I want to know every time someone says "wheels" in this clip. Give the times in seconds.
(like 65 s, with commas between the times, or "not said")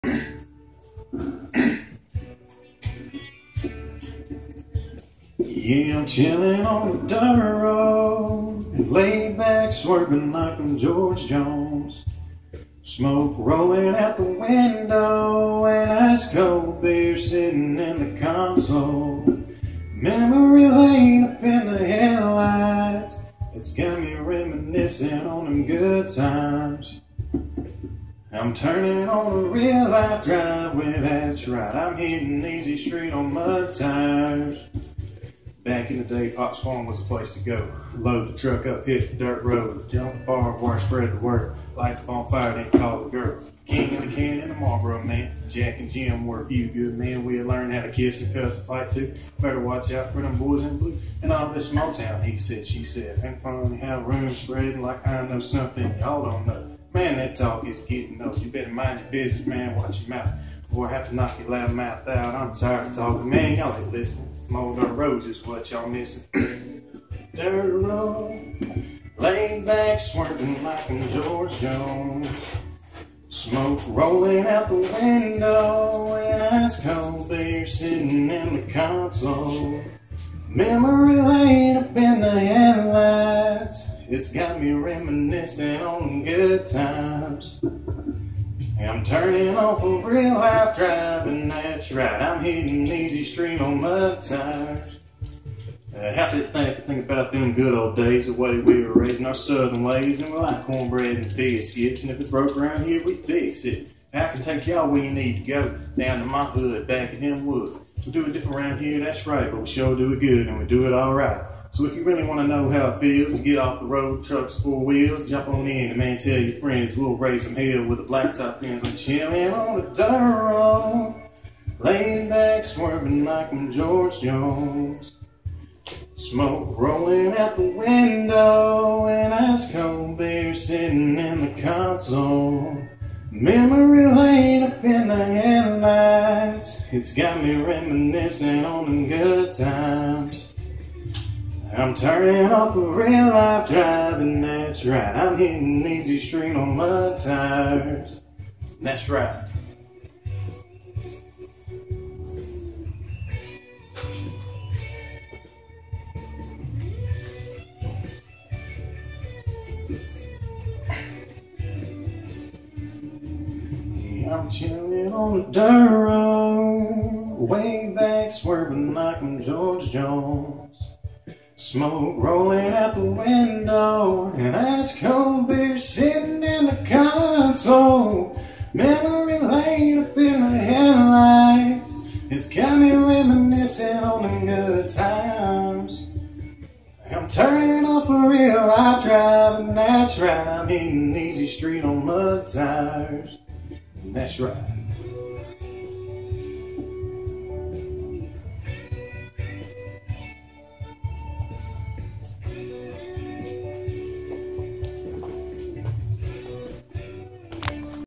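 114 s.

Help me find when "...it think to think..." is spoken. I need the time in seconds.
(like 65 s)
96 s.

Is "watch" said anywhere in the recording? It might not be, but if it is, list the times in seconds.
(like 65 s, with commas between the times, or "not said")
49 s, 59 s.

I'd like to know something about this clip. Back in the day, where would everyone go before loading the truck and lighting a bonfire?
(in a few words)
Pop's Farm.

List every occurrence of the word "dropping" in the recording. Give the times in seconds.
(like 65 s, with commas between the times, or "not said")
not said.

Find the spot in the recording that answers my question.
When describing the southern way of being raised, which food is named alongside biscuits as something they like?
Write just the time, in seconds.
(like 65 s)
100 s.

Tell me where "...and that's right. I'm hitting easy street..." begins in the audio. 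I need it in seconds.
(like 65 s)
144 s.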